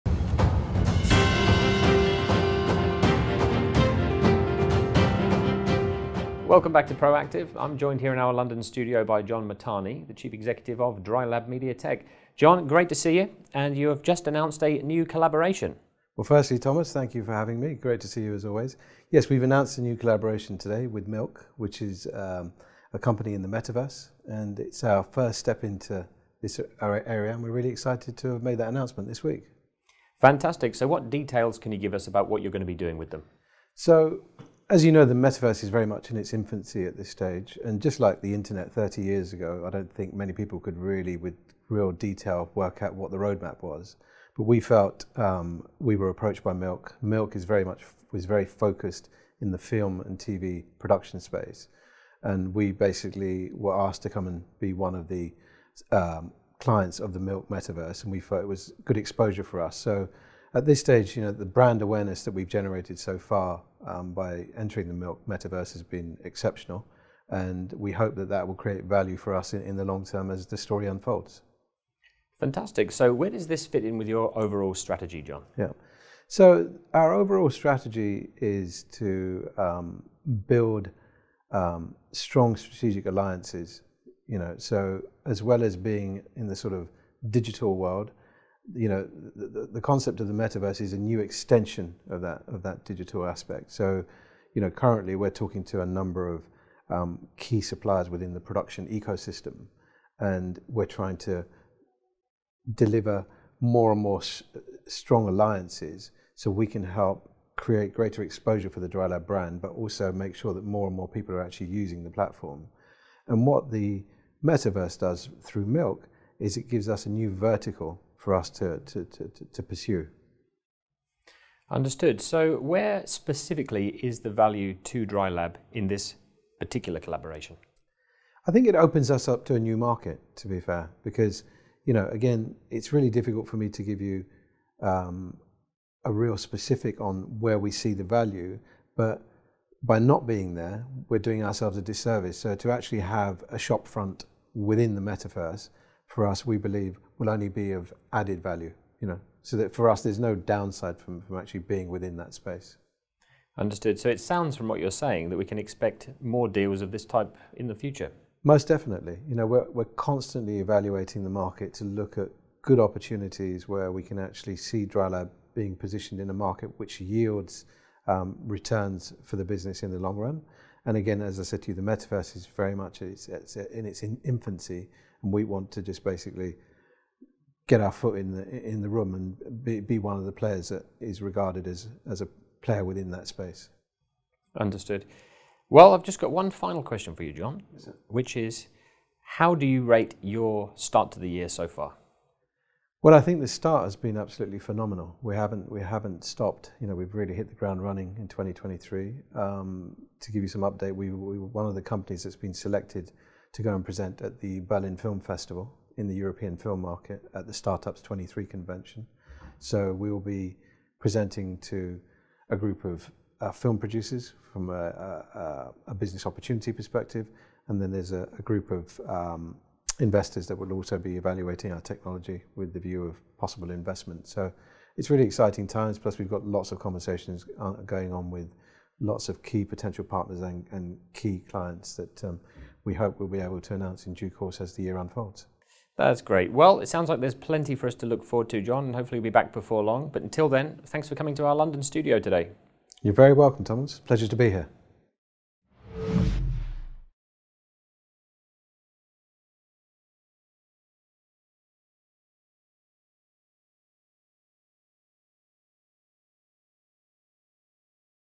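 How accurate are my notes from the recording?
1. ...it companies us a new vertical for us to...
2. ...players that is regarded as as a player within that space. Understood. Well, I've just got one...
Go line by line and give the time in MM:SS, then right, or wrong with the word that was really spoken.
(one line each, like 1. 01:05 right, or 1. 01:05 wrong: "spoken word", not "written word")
1. 01:56 wrong: "gives", not "companies"
2. 03:00 right.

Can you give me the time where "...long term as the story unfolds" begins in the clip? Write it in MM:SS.
01:09.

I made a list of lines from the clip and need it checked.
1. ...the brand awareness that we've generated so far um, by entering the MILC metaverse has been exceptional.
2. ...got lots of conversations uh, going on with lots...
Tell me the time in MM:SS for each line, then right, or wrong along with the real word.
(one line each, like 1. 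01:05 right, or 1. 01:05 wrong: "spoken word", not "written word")
1. 01:01 right
2. 03:46 right.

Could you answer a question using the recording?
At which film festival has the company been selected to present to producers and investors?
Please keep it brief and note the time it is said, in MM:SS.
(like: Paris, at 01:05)
Berlin Film Festival, at 03:24.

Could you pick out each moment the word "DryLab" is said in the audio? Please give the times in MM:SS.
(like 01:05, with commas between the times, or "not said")
00:11, 01:48, 02:05, 02:44.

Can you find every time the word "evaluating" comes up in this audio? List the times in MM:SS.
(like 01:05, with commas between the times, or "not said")
02:40, 03:41.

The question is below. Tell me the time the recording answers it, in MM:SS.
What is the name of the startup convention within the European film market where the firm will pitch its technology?
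03:27.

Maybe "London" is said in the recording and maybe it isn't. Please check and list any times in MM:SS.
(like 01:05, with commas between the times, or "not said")
00:08, 04:01.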